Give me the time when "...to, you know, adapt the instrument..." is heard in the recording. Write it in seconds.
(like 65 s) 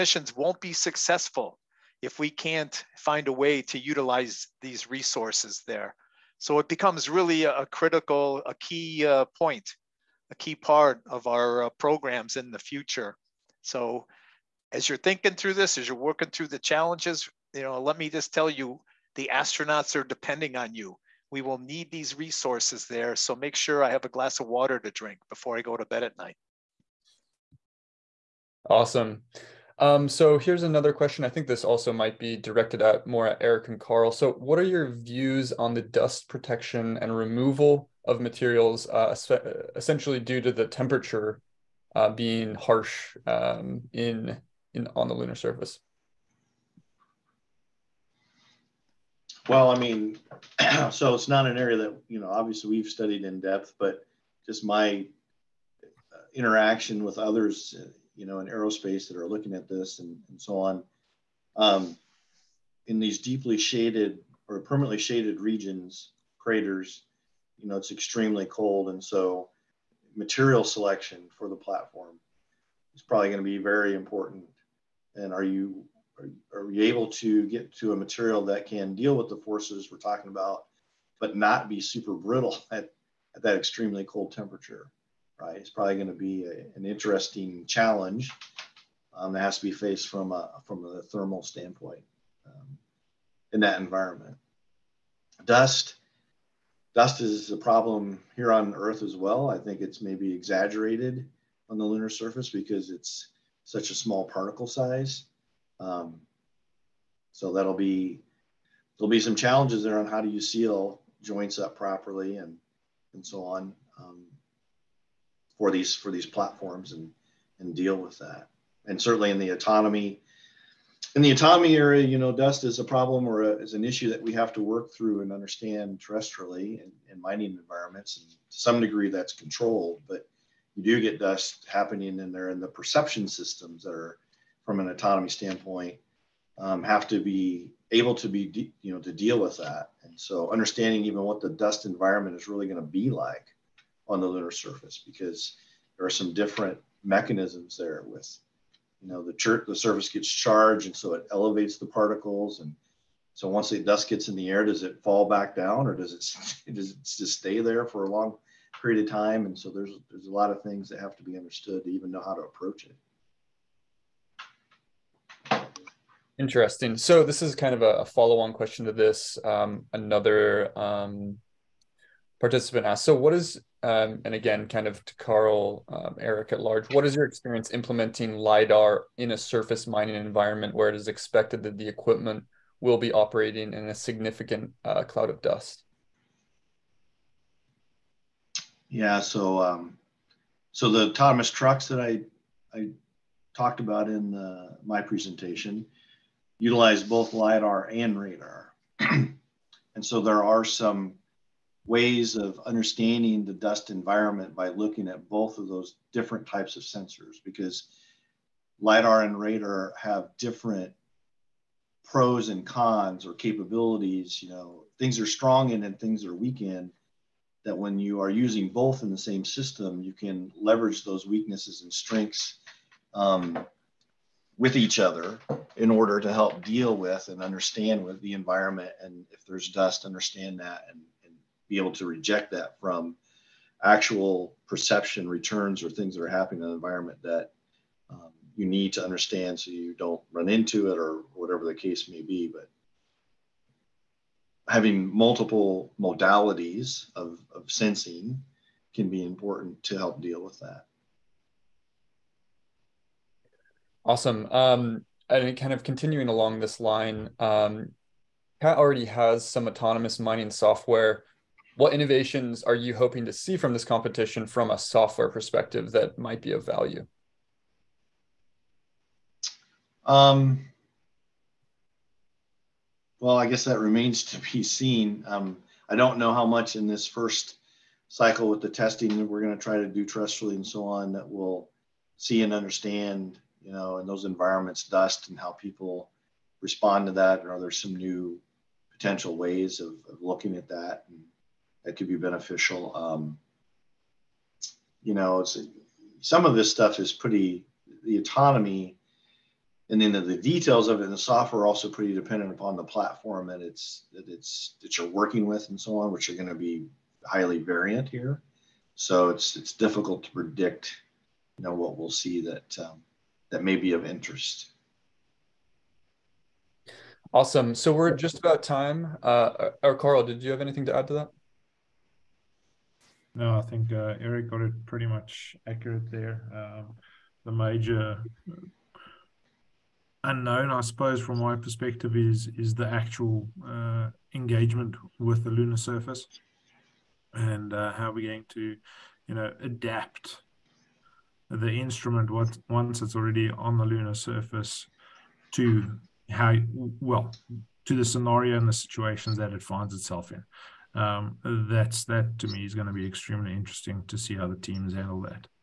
338 s.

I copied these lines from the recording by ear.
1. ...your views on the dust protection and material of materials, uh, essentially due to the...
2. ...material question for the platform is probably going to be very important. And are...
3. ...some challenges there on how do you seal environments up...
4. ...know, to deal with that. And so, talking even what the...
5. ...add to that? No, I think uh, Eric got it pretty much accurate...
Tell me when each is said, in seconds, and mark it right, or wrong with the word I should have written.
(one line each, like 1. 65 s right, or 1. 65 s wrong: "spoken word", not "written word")
1. 34 s wrong: "removal", not "material"
2. 70 s wrong: "selection", not "question"
3. 109 s wrong: "joints", not "environments"
4. 138 s wrong: "understanding", not "talking"
5. 320 s right.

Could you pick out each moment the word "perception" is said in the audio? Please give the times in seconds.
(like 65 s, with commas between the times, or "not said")
132 s, 234 s.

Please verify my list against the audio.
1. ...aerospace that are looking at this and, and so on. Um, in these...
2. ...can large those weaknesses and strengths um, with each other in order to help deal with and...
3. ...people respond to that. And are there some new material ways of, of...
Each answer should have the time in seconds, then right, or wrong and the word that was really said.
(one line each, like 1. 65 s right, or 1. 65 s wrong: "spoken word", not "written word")
1. 58 s right
2. 220 s wrong: "leverage", not "large"
3. 285 s wrong: "potential", not "material".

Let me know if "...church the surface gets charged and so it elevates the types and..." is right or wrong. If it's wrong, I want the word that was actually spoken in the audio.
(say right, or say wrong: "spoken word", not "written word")
wrong: "particles", not "types".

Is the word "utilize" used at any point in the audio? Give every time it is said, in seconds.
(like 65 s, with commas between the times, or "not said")
3 s, 196 s.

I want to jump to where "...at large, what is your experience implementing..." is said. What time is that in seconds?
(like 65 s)
176 s.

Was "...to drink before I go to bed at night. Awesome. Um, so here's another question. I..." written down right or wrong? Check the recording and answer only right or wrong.
right.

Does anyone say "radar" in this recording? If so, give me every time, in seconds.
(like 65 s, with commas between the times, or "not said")
198 s, 209 s.